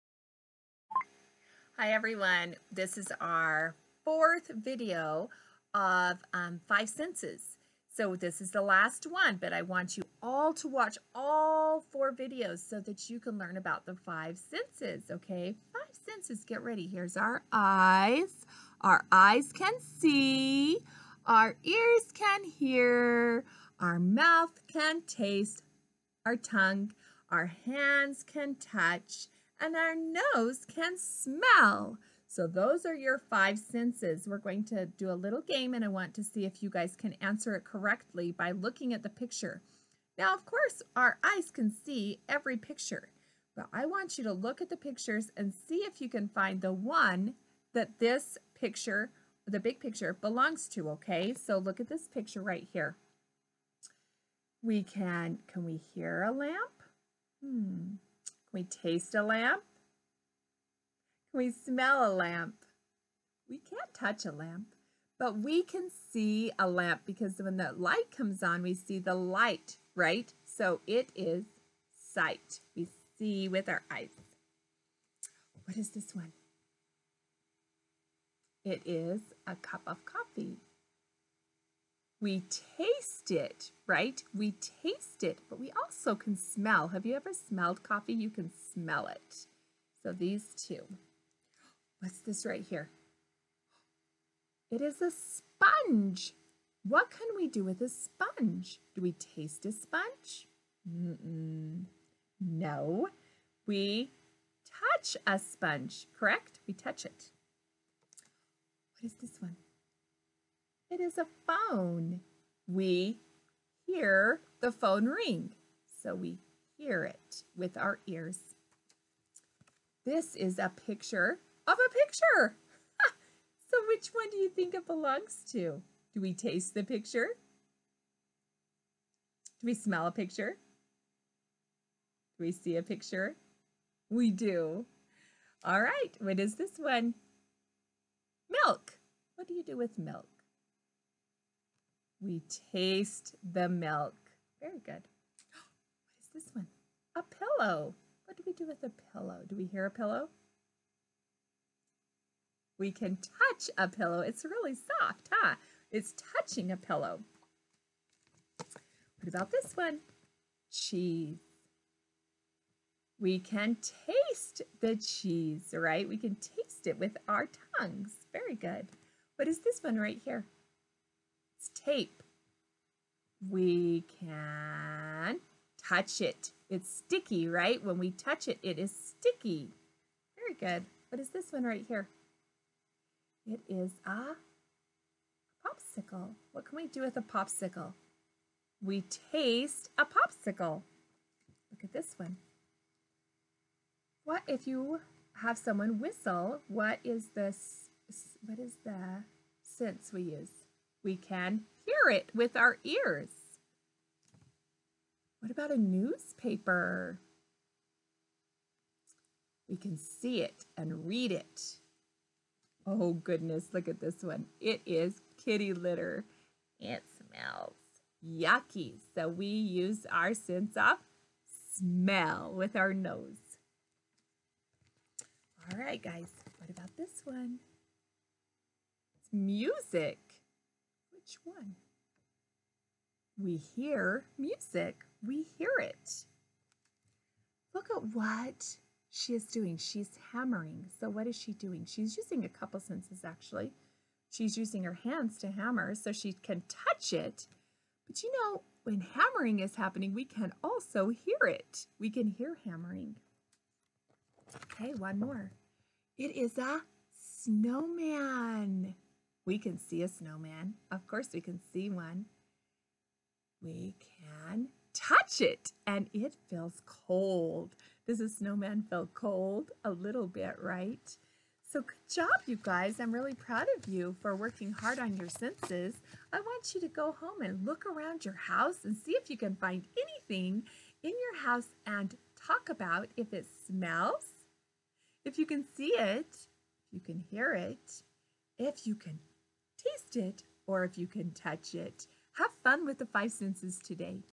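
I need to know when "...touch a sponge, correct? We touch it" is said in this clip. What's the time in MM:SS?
01:44.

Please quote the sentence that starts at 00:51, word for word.
So look at this picture right here.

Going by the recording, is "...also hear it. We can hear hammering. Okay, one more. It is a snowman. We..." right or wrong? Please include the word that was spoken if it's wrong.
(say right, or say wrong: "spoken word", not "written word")
right.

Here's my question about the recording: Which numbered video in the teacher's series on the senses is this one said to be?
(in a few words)
fourth.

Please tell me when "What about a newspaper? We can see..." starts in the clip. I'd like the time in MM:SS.
03:25.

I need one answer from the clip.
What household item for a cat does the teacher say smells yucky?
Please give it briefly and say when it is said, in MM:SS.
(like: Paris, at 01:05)
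kitty litter, at 03:35.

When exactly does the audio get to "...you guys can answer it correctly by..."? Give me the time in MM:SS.
00:36.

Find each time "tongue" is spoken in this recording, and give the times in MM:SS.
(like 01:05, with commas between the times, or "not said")
00:26, 02:47.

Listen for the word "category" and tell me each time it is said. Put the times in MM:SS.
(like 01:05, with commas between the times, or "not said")
not said.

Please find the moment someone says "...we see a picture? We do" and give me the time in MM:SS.
02:12.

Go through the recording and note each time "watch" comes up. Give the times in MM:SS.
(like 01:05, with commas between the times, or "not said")
00:10.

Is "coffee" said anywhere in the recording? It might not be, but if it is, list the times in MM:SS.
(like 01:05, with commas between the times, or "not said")
01:20, 01:27.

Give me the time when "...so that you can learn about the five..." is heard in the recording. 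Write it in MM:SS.
00:12.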